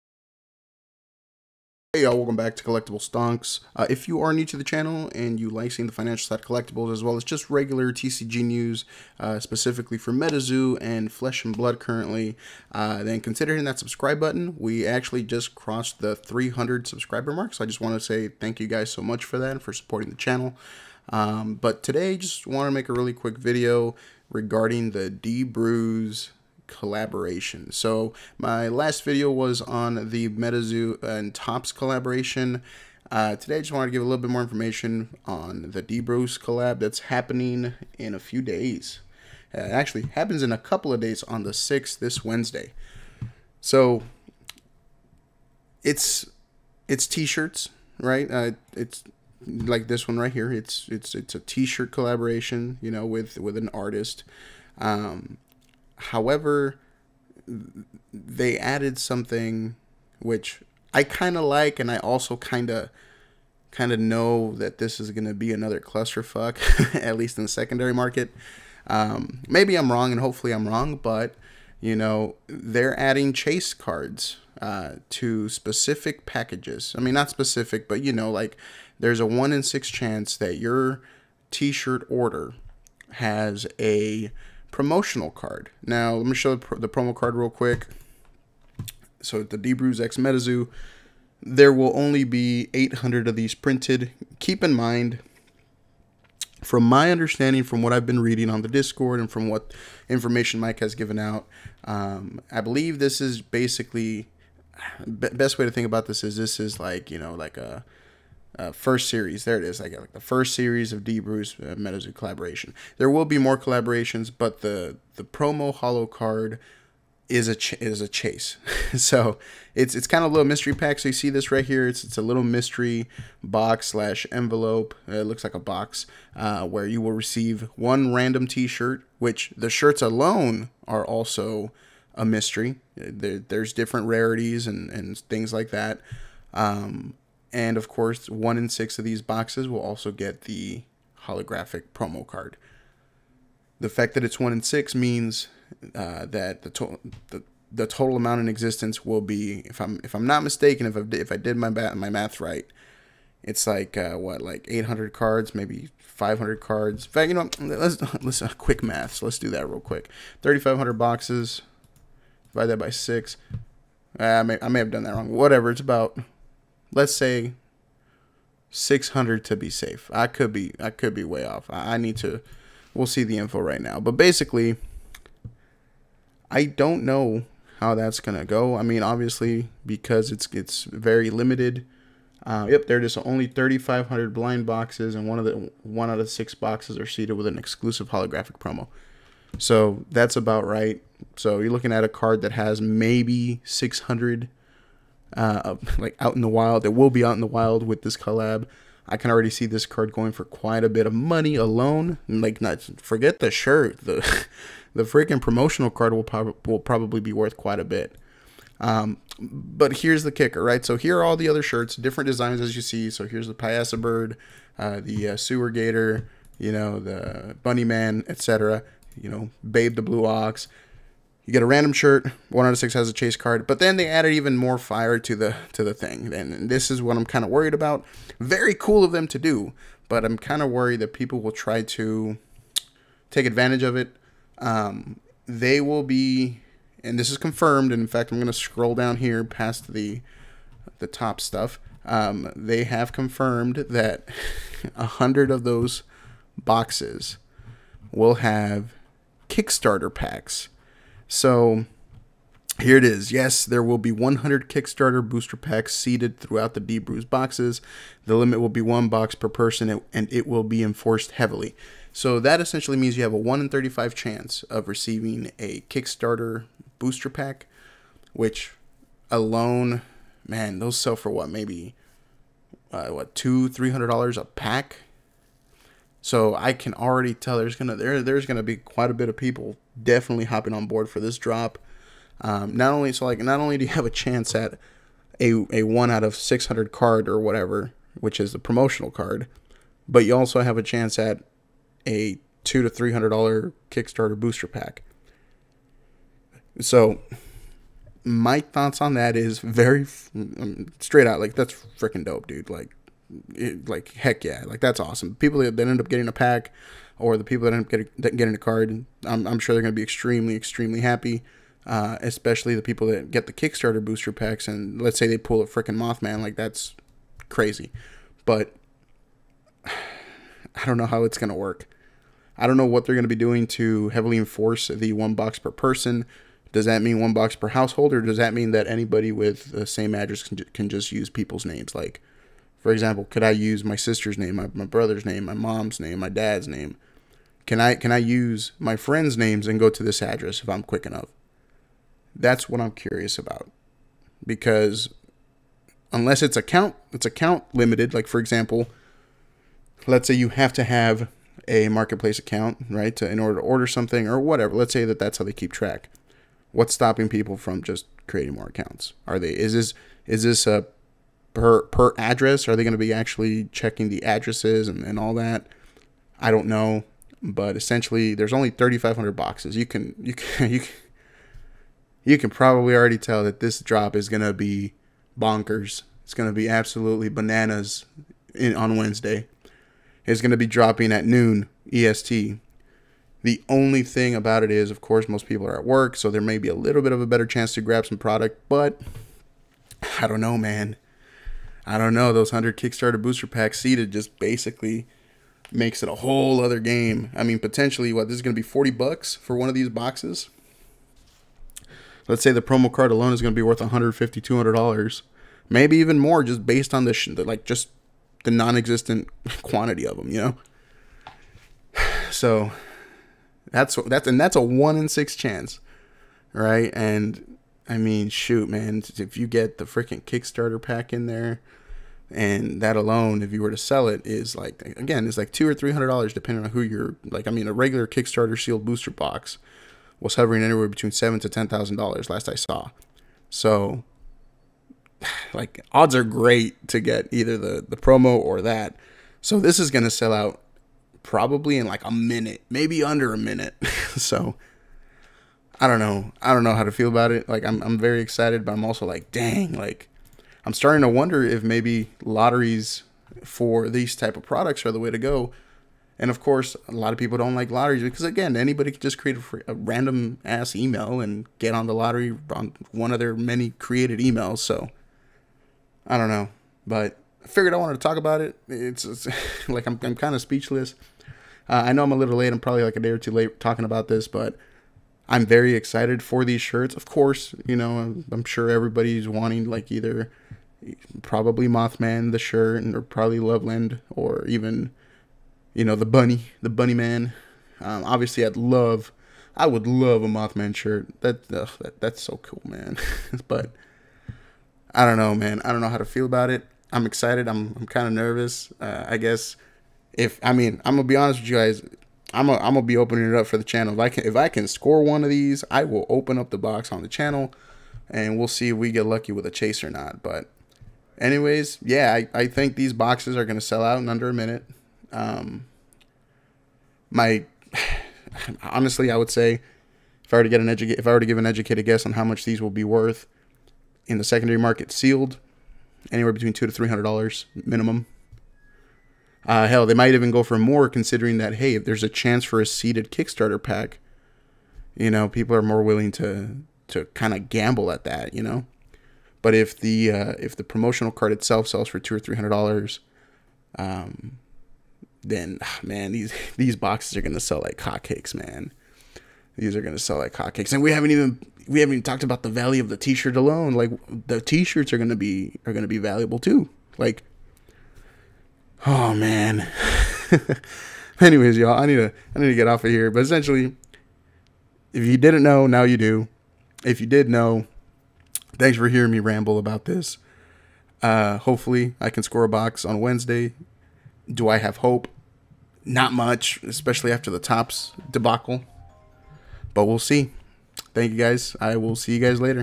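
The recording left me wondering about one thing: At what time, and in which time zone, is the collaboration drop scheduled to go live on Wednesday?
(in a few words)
noon EST.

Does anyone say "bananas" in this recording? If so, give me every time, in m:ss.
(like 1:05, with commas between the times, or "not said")
6:17.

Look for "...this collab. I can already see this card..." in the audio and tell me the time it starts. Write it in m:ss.
3:18.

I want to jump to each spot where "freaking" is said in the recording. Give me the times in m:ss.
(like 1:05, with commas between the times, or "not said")
3:25, 5:01, 5:15, 6:59.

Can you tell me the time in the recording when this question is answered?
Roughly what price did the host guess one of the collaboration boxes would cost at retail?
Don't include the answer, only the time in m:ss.
6:38.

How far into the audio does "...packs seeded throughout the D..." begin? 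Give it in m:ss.
4:15.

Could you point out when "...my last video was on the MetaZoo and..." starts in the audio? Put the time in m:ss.
0:28.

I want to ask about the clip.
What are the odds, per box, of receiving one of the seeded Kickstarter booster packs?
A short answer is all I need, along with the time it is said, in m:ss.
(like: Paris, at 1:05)
1 in 35, at 4:23.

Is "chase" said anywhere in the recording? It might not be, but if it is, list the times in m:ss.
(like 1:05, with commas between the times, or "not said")
1:13, 1:58, 3:43, 8:29.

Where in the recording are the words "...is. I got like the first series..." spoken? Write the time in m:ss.
1:49.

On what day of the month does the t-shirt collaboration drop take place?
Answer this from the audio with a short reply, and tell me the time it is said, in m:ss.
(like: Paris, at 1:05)
6th, at 0:41.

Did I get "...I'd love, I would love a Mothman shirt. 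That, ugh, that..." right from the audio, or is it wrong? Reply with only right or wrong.
right.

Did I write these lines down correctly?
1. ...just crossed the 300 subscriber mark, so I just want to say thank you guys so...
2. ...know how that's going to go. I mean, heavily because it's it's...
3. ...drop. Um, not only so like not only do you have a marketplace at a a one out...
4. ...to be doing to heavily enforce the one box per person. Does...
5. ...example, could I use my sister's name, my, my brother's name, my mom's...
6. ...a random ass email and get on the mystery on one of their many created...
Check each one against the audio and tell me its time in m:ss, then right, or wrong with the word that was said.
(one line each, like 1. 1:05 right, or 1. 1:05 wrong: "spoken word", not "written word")
1. 0:15 right
2. 2:57 wrong: "obviously", not "heavily"
3. 4:41 wrong: "chance", not "marketplace"
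4. 5:23 right
5. 5:32 right
6. 7:39 wrong: "lottery", not "mystery".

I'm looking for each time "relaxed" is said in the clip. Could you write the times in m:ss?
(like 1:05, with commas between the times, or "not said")
not said.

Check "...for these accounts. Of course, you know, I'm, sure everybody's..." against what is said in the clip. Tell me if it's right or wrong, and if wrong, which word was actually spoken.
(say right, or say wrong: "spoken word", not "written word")
wrong: "shirts", not "accounts".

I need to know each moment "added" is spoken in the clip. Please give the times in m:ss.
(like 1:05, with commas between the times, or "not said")
0:58, 3:44.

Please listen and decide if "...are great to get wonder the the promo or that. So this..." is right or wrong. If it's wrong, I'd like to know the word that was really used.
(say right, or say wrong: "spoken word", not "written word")
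wrong: "either", not "wonder".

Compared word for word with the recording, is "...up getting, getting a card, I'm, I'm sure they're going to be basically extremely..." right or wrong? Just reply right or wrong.
wrong.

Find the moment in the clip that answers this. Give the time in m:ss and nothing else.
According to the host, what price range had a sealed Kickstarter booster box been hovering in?
7:11.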